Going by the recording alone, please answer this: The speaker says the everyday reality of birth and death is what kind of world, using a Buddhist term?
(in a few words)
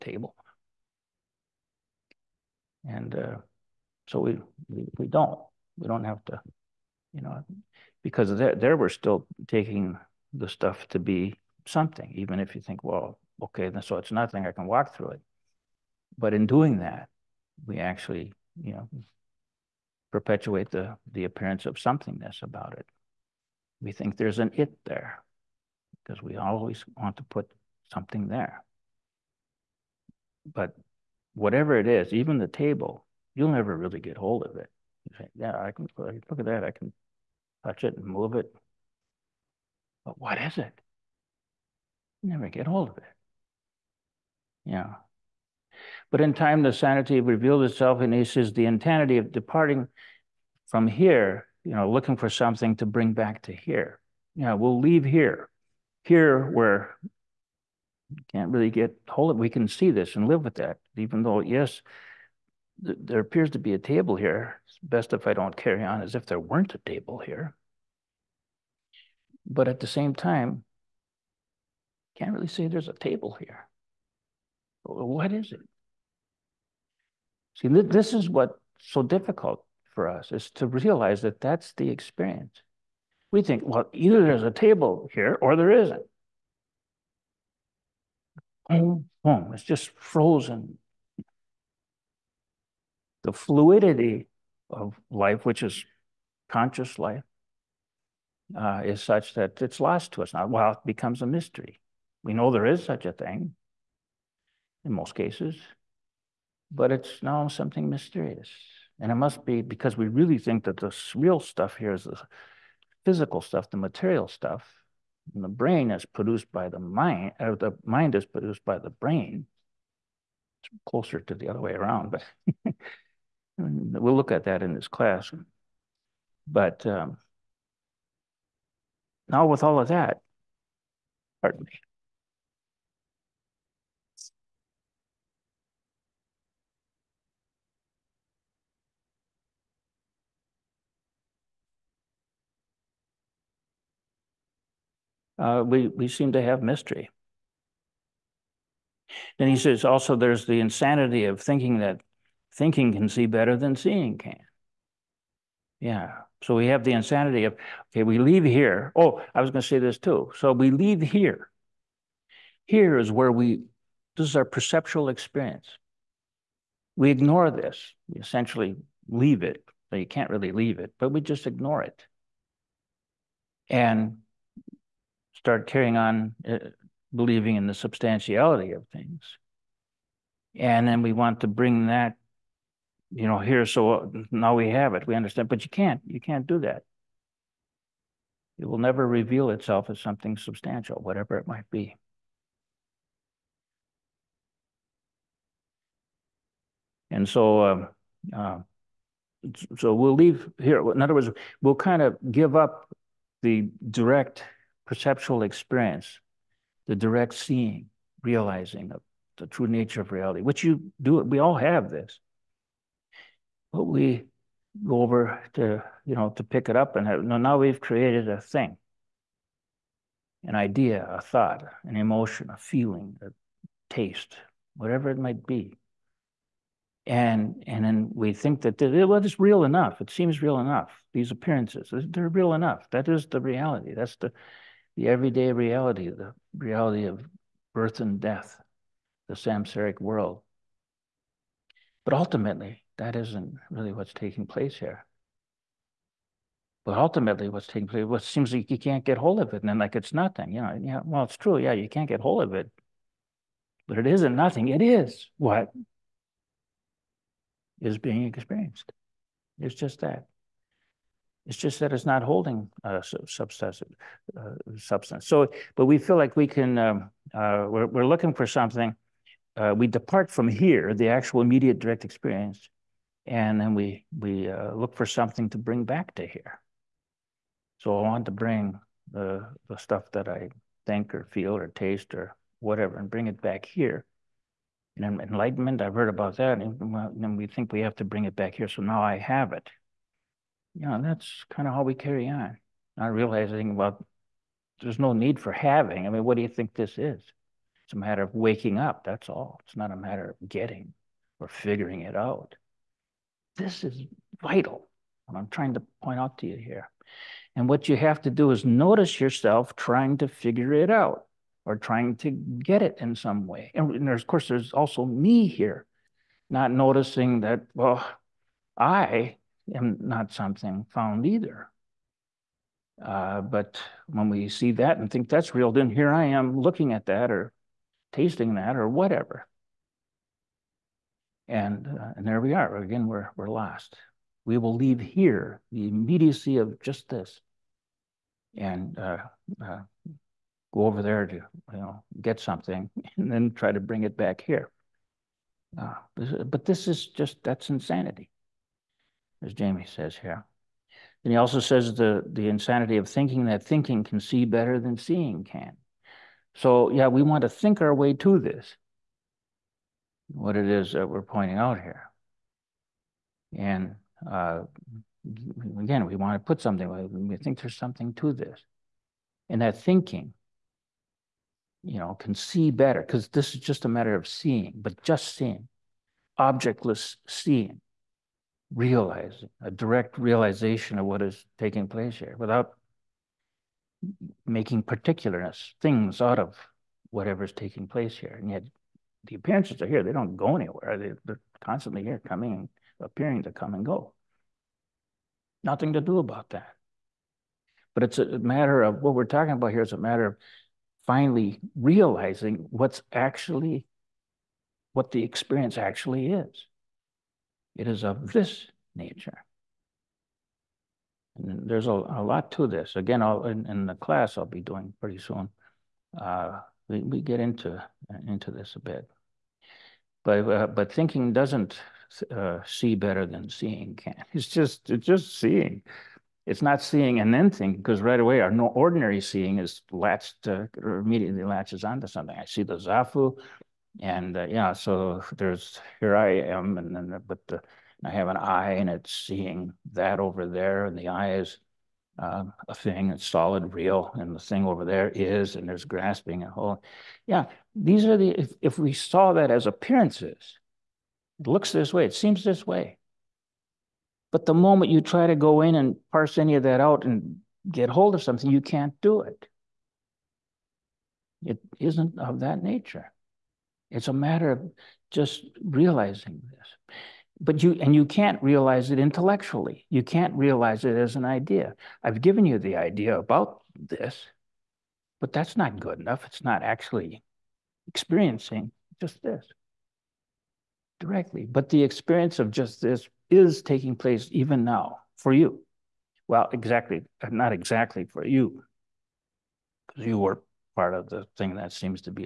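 samsaric.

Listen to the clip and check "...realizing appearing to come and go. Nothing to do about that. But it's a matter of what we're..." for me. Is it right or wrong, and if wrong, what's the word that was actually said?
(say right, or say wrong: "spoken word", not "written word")
wrong: "coming", not "realizing".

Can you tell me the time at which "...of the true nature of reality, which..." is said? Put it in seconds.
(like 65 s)
208 s.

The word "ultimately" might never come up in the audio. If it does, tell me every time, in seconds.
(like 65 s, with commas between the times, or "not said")
242 s, 246 s.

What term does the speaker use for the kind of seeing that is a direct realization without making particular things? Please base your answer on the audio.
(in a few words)
objectless seeing.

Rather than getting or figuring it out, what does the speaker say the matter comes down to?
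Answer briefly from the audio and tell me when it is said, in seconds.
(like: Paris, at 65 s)
waking up, at 298 s.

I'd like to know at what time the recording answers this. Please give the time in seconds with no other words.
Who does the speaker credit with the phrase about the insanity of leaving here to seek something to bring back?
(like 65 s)
349 s.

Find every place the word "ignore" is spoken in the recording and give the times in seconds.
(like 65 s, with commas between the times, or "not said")
167 s, 171 s.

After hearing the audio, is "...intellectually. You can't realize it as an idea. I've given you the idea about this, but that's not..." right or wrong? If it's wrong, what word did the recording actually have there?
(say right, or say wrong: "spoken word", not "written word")
right.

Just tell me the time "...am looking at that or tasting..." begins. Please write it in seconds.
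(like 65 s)
326 s.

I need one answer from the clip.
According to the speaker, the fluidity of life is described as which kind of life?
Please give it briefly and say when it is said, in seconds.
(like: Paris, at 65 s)
conscious life, at 96 s.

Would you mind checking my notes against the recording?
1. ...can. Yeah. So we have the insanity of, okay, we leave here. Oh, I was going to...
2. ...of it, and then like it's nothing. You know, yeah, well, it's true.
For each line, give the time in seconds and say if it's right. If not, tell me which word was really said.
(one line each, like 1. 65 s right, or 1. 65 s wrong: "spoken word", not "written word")
1. 154 s right
2. 249 s right.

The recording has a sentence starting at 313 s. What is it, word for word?
And, of course, there's also me here, not noticing that, well, I not something found either.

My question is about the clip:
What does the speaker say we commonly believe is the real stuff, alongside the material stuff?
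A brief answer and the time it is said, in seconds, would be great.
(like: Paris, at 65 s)
physical stuff, at 112 s.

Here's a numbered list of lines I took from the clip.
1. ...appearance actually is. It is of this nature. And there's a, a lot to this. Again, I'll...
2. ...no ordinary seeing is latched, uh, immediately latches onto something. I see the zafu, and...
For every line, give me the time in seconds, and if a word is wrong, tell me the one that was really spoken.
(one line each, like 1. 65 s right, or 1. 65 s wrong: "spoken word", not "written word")
1. 405 s wrong: "experience", not "appearance"
2. 428 s right.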